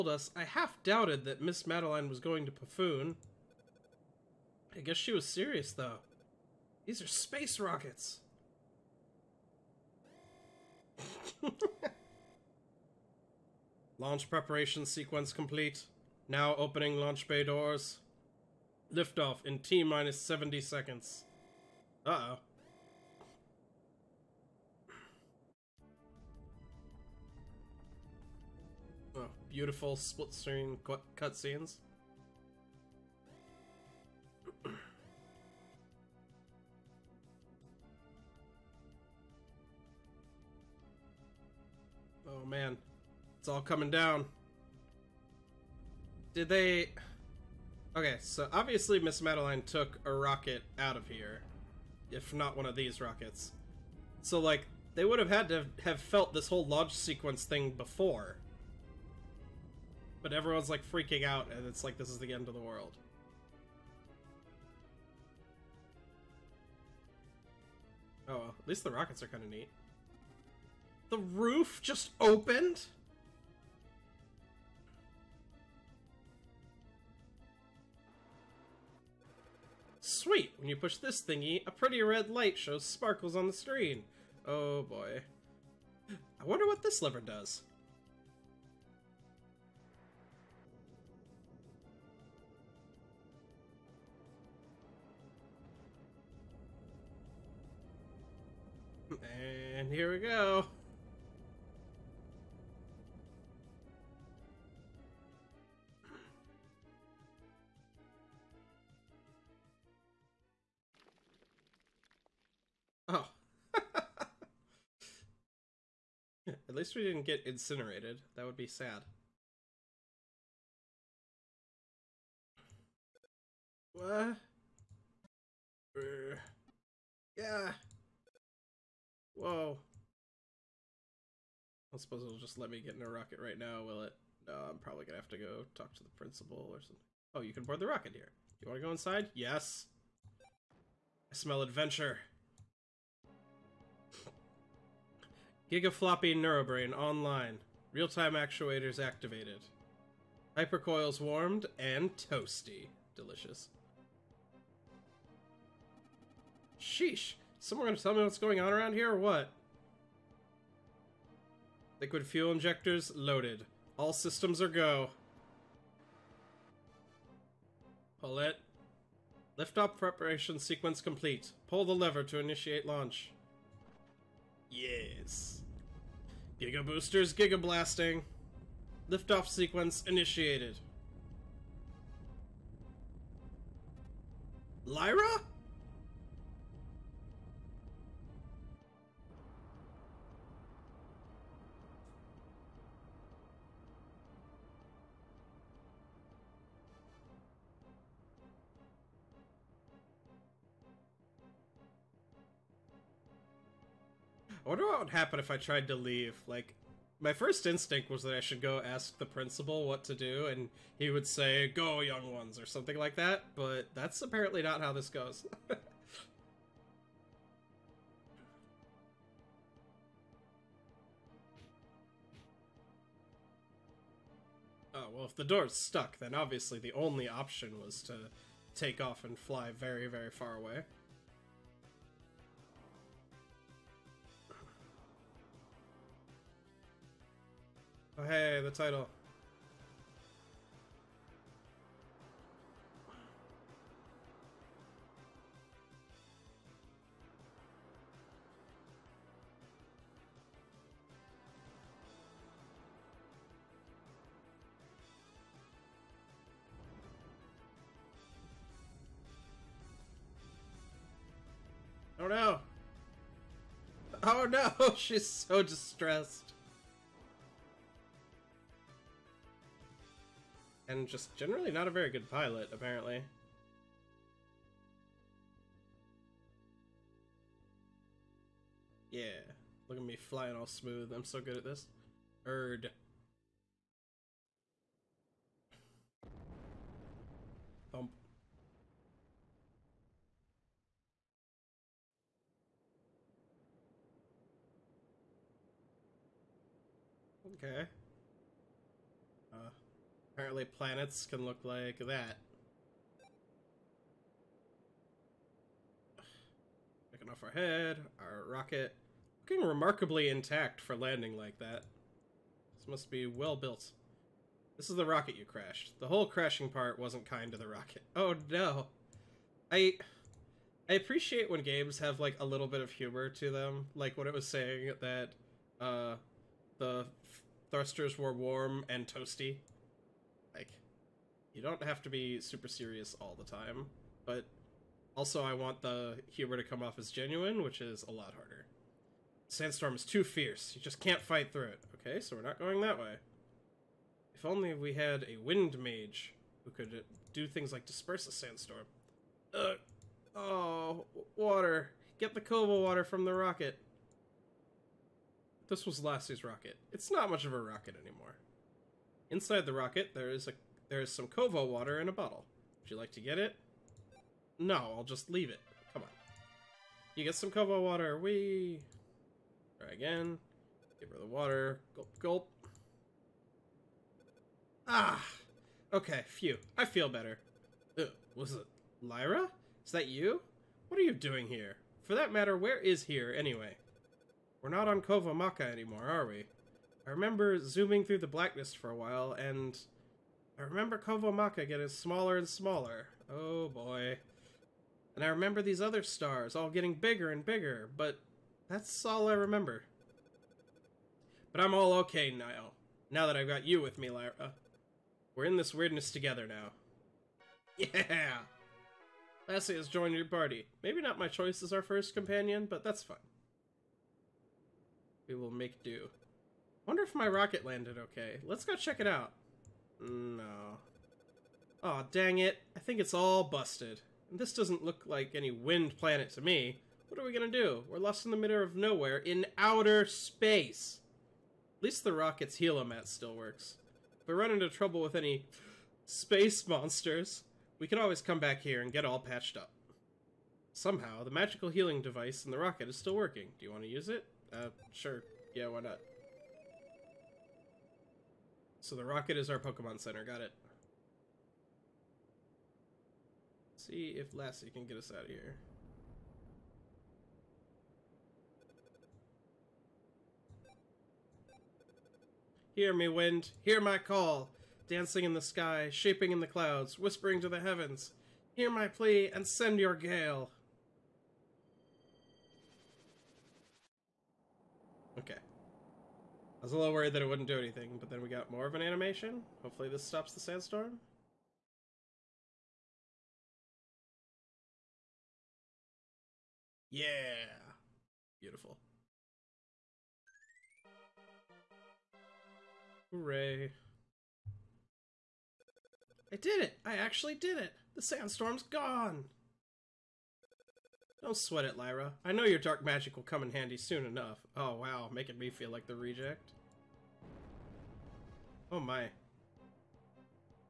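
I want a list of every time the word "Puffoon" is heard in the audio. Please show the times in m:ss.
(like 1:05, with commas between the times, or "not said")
0:02.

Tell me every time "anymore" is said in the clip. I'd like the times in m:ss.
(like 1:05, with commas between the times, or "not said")
5:57, 6:25.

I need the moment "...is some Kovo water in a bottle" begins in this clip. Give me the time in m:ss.
6:01.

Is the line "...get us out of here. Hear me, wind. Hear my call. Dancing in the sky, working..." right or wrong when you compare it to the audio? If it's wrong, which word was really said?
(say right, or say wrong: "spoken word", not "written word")
wrong: "shaping", not "working".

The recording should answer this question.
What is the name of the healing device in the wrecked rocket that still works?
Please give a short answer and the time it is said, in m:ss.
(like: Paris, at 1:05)
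helomat, at 7:12.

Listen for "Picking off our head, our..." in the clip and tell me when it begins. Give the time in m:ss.
5:07.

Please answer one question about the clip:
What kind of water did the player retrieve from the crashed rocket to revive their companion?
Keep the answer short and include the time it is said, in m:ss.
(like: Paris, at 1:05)
Kova water, at 5:52.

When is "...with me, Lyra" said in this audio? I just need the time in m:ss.
6:43.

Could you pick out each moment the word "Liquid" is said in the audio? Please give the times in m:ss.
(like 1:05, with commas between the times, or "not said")
2:41.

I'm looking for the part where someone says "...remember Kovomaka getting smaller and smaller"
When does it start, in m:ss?
6:30.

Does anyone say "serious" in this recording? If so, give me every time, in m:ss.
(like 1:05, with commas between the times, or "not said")
0:05, 5:32.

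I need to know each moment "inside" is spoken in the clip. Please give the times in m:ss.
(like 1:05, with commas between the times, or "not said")
2:18, 5:59.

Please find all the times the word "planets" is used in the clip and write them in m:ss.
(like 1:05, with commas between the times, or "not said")
5:00, 7:05.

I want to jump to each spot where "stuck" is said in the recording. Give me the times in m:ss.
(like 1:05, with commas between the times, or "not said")
3:45.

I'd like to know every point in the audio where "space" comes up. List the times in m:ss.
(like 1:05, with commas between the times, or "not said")
0:07, 7:10, 7:16.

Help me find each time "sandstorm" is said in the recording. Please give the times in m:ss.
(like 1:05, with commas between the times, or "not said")
5:39, 5:48, 8:00, 8:18.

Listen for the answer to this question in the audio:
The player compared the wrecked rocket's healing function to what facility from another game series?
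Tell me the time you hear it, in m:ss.
7:29.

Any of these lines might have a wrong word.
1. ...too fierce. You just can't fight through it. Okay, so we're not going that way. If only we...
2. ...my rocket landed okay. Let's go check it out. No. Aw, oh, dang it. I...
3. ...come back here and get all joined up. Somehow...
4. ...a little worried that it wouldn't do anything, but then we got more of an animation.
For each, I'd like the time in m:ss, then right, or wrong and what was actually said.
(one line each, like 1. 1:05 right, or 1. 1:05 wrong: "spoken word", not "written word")
1. 5:40 right
2. 6:57 right
3. 7:18 wrong: "patched", not "joined"
4. 7:56 right.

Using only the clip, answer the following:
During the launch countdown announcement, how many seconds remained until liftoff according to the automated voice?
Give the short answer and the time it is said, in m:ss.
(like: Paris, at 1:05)
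70, at 0:19.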